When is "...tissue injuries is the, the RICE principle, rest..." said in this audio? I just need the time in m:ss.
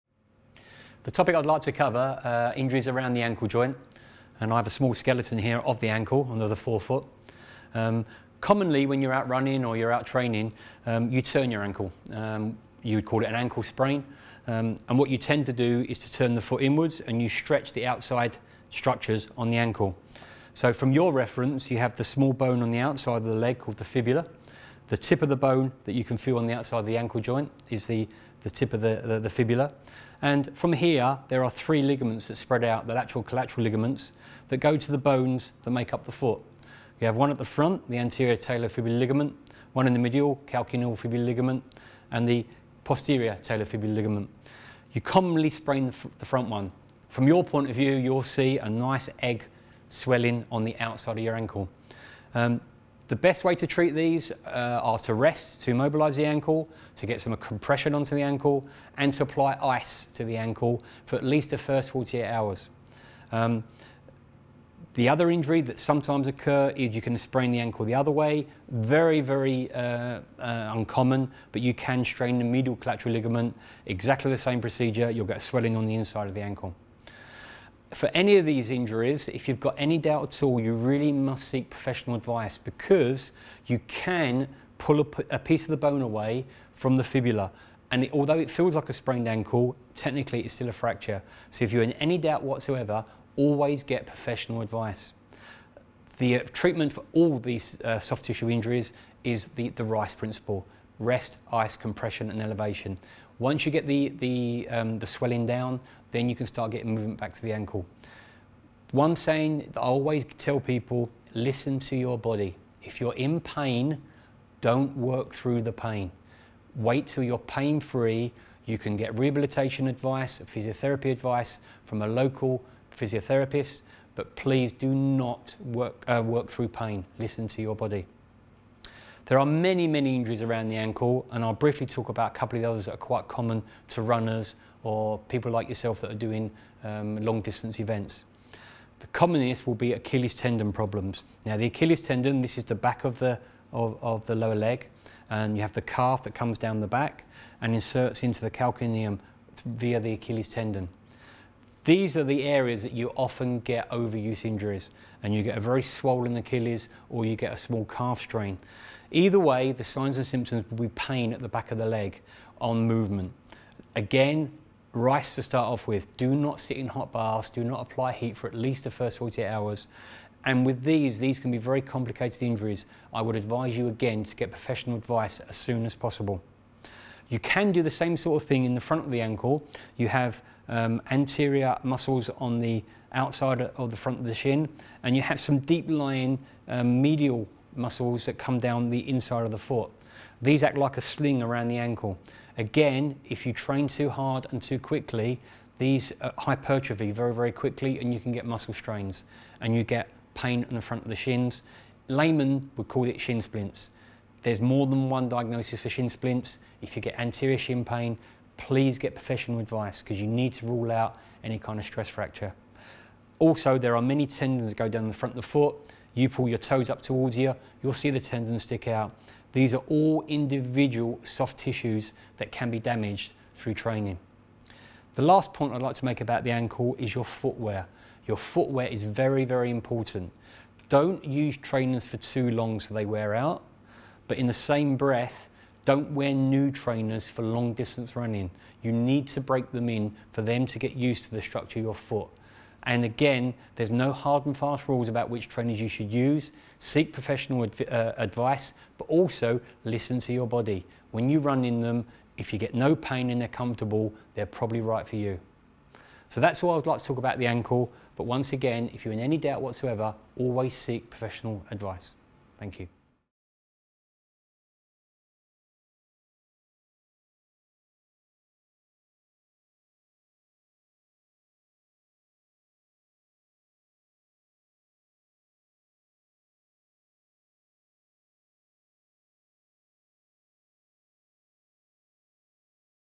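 1:38.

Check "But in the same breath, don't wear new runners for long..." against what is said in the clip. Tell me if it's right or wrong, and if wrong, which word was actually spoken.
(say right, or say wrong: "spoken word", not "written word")
wrong: "trainers", not "runners".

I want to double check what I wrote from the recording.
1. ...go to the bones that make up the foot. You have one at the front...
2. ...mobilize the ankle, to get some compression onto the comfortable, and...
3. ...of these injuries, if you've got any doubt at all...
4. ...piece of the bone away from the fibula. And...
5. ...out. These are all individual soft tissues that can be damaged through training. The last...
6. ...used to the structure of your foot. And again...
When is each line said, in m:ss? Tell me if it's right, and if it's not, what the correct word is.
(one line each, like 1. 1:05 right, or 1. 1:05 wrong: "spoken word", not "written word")
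1. 0:34 right
2. 0:55 wrong: "ankle", not "comfortable"
3. 1:18 right
4. 1:25 right
5. 3:38 right
6. 4:00 right.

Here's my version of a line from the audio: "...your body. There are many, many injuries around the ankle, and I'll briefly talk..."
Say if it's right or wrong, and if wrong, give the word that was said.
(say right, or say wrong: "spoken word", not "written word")
right.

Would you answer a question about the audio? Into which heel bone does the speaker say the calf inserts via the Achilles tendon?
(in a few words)
Calcaneum.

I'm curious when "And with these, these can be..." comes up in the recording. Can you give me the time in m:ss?
2:50.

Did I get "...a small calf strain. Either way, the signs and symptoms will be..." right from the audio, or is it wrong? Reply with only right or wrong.
right.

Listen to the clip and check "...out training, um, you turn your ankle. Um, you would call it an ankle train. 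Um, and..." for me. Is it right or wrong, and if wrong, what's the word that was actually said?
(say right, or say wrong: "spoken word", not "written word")
wrong: "sprain", not "train".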